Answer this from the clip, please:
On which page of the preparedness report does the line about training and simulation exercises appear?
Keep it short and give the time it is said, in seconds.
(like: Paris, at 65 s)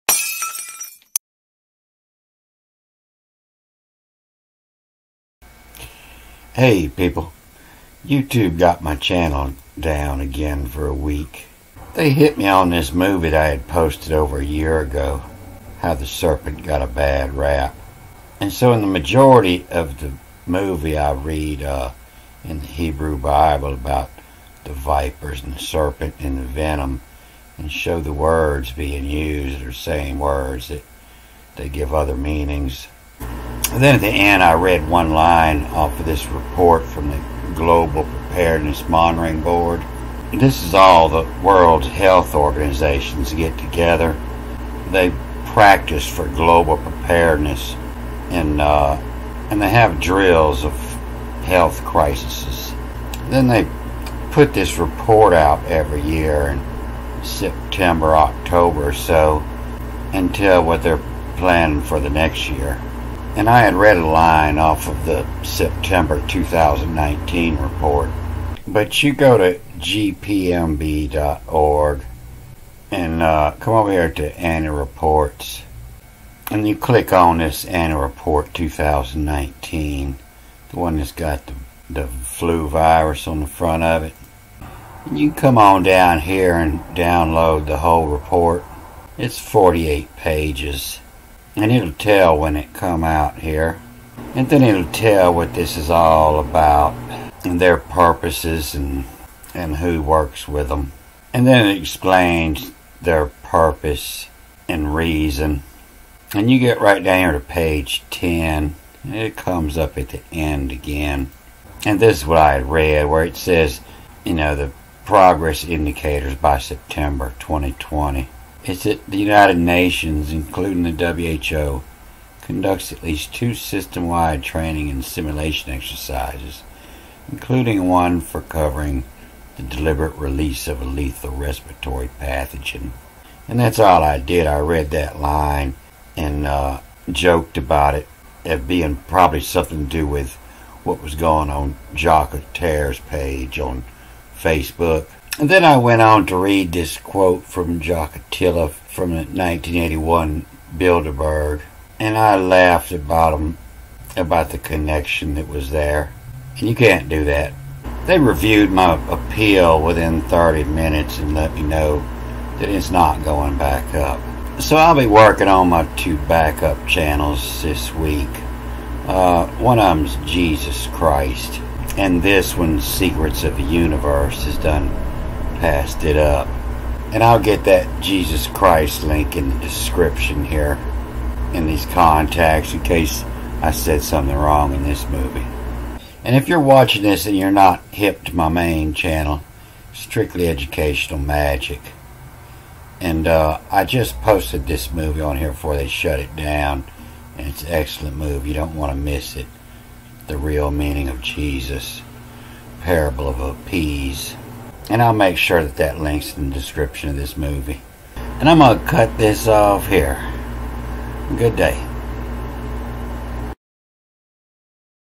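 10, at 107 s.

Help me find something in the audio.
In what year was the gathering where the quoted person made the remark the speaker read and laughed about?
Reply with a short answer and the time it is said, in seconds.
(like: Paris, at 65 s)
1981, at 149 s.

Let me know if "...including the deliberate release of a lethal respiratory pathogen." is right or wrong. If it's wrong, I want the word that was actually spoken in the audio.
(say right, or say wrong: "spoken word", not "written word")
wrong: "covering", not "including".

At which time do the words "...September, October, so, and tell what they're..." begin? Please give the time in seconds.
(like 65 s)
57 s.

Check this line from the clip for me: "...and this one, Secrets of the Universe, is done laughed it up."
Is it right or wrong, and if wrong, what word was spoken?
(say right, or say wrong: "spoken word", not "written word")
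wrong: "passed", not "laughed".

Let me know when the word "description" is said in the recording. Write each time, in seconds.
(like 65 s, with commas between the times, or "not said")
179 s, 206 s.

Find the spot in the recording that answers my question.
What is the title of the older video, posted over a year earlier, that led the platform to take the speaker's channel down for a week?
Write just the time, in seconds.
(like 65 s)
15 s.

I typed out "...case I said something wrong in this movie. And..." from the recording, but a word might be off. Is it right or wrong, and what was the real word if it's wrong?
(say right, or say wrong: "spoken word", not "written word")
right.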